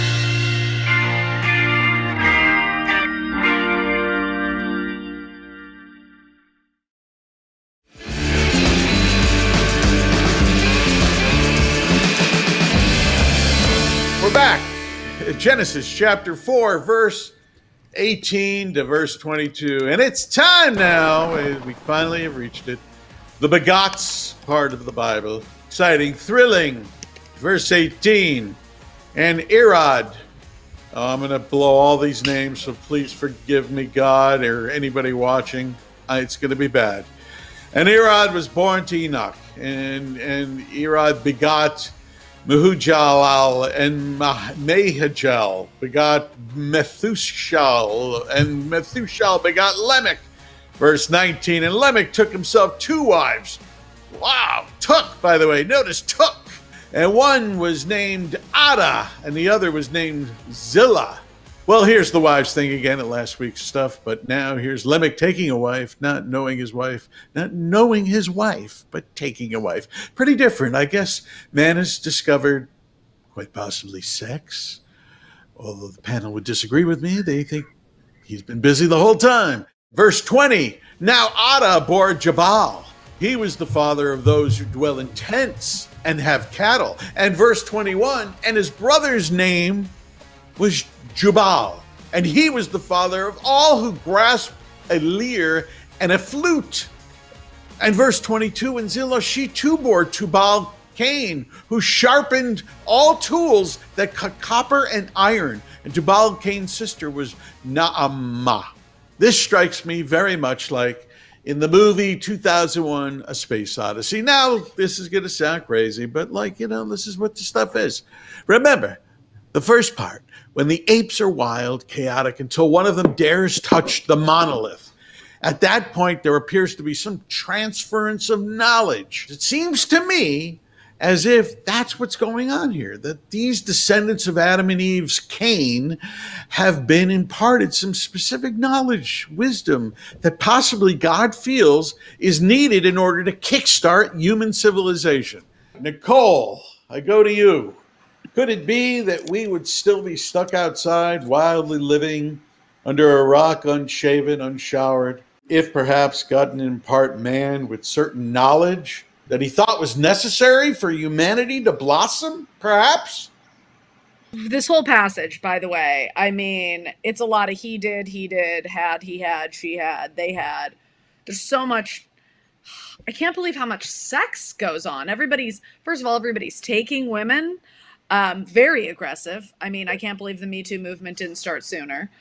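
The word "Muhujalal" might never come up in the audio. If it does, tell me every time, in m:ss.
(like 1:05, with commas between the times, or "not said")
0:42.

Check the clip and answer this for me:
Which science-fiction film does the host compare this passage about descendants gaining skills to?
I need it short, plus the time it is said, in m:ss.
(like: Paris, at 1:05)
2001: A Space Odyssey, at 1:52.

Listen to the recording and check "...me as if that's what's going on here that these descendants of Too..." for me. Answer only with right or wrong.
wrong.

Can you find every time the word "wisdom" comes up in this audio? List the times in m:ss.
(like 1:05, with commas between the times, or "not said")
2:19.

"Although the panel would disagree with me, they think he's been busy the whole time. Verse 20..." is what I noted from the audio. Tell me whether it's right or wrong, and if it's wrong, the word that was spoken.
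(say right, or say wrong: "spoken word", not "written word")
right.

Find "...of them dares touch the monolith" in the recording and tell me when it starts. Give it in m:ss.
2:02.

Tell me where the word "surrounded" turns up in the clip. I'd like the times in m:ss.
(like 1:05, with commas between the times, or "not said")
not said.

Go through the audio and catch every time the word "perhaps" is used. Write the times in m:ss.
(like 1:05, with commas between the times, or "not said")
2:35, 2:42.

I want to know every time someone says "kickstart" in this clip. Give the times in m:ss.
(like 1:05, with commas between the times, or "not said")
2:23.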